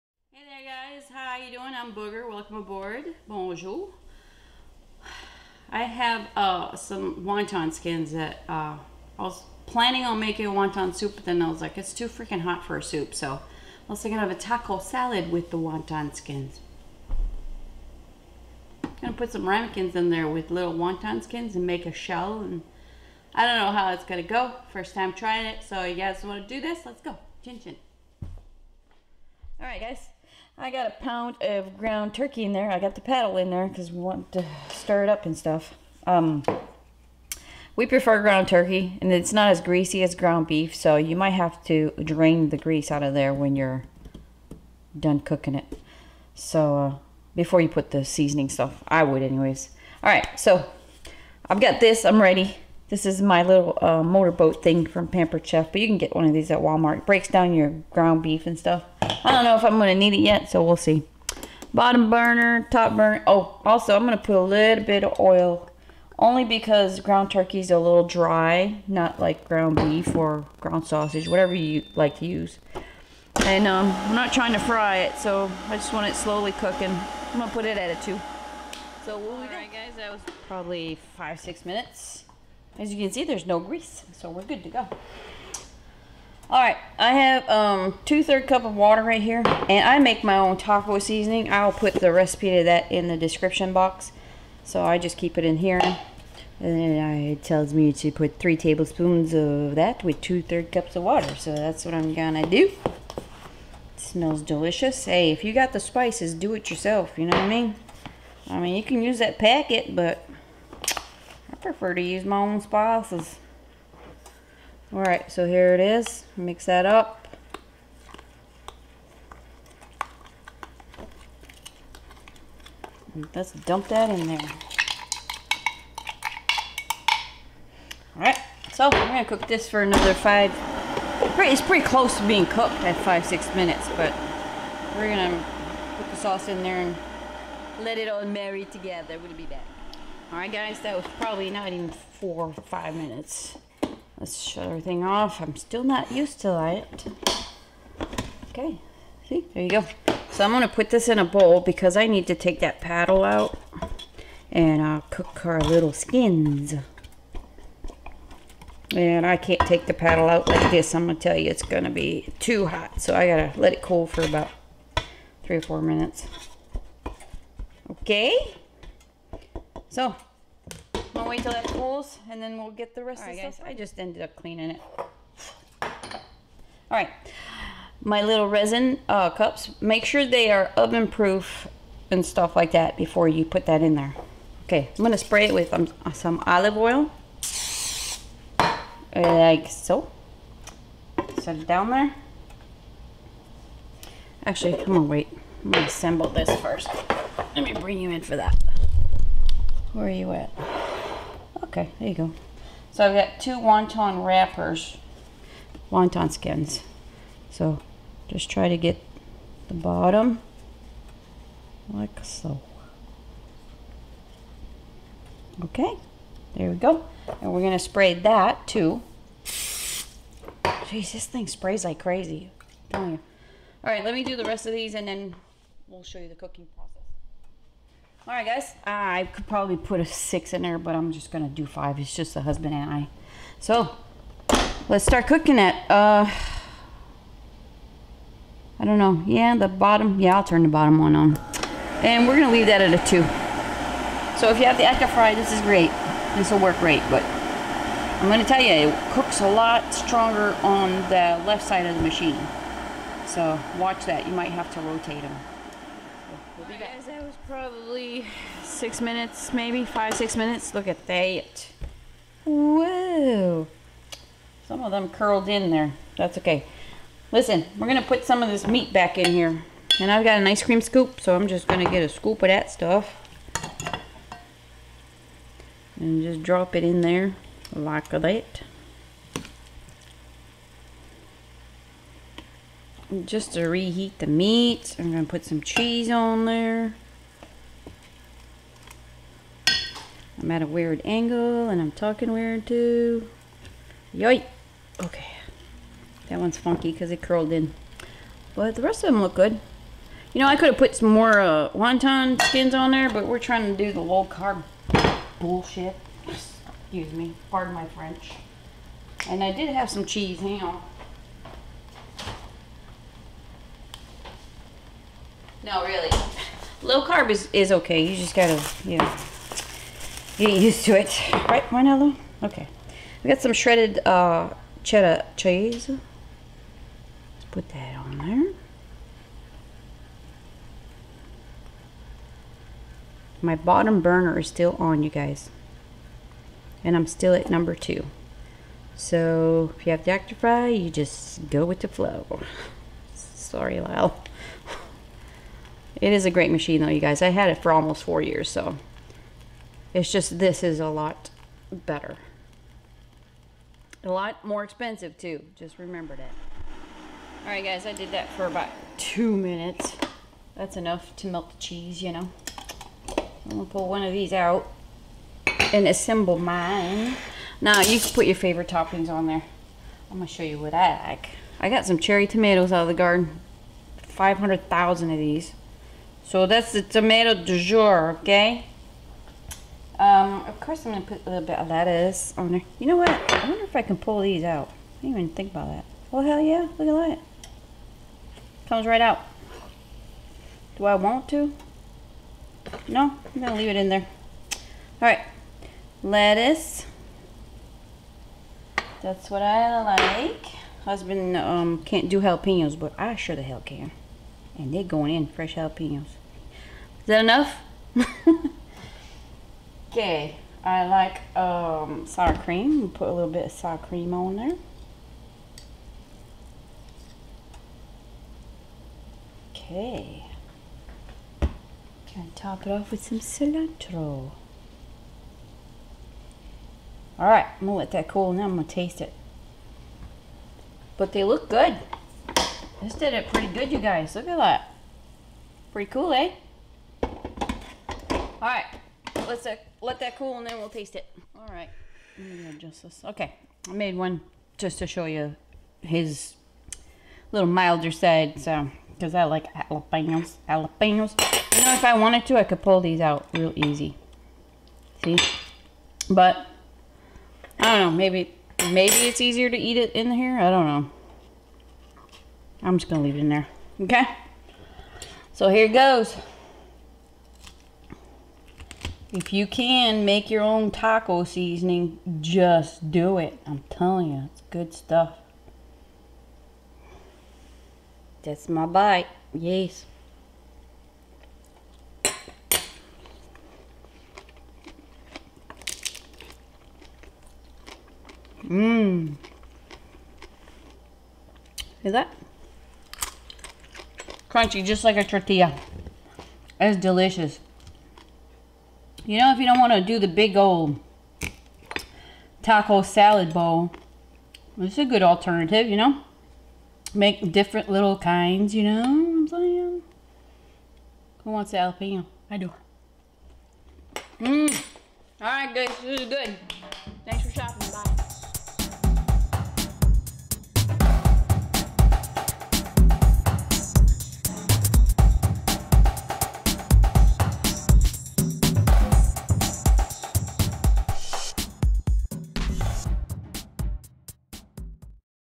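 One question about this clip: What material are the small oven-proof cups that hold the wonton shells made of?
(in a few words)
resin.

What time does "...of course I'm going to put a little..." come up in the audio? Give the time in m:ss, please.
6:20.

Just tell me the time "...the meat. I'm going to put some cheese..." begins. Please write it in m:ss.
4:44.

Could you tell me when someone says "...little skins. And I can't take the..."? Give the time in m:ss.
2:35.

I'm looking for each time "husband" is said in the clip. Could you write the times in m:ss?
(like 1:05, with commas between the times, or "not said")
3:52, 6:40.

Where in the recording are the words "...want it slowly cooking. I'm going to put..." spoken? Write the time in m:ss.
1:15.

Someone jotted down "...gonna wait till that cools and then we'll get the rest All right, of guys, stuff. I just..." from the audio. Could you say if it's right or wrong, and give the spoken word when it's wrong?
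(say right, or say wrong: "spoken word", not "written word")
right.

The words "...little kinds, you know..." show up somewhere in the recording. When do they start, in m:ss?
8:27.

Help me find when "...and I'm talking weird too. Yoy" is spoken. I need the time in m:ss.
4:51.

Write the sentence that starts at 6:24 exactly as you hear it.
I didn't even think about that.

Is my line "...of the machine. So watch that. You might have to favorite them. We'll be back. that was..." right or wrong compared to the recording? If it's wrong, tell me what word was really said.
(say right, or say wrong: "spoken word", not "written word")
wrong: "rotate", not "favorite".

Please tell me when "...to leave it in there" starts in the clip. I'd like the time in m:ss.
6:33.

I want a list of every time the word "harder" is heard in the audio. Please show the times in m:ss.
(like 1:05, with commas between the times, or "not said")
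not said.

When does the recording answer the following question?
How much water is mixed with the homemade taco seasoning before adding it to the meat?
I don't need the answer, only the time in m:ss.
1:28.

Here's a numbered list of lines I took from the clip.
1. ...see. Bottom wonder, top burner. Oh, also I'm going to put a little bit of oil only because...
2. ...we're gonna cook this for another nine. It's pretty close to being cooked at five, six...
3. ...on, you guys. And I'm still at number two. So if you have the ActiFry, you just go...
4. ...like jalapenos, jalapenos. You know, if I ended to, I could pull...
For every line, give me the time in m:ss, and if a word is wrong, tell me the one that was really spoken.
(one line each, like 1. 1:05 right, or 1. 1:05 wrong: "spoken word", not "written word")
1. 1:00 wrong: "burner", not "wonder"
2. 2:08 wrong: "five", not "nine"
3. 5:34 right
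4. 7:29 wrong: "wanted", not "ended".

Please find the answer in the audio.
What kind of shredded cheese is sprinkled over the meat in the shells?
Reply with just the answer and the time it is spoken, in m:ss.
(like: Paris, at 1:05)
cheddar, at 5:24.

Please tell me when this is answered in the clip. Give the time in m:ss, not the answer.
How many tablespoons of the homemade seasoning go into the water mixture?
1:38.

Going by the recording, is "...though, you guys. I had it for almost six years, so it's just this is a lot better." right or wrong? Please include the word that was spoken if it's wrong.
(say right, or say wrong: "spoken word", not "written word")
wrong: "four", not "six".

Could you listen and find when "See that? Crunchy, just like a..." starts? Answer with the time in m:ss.
8:11.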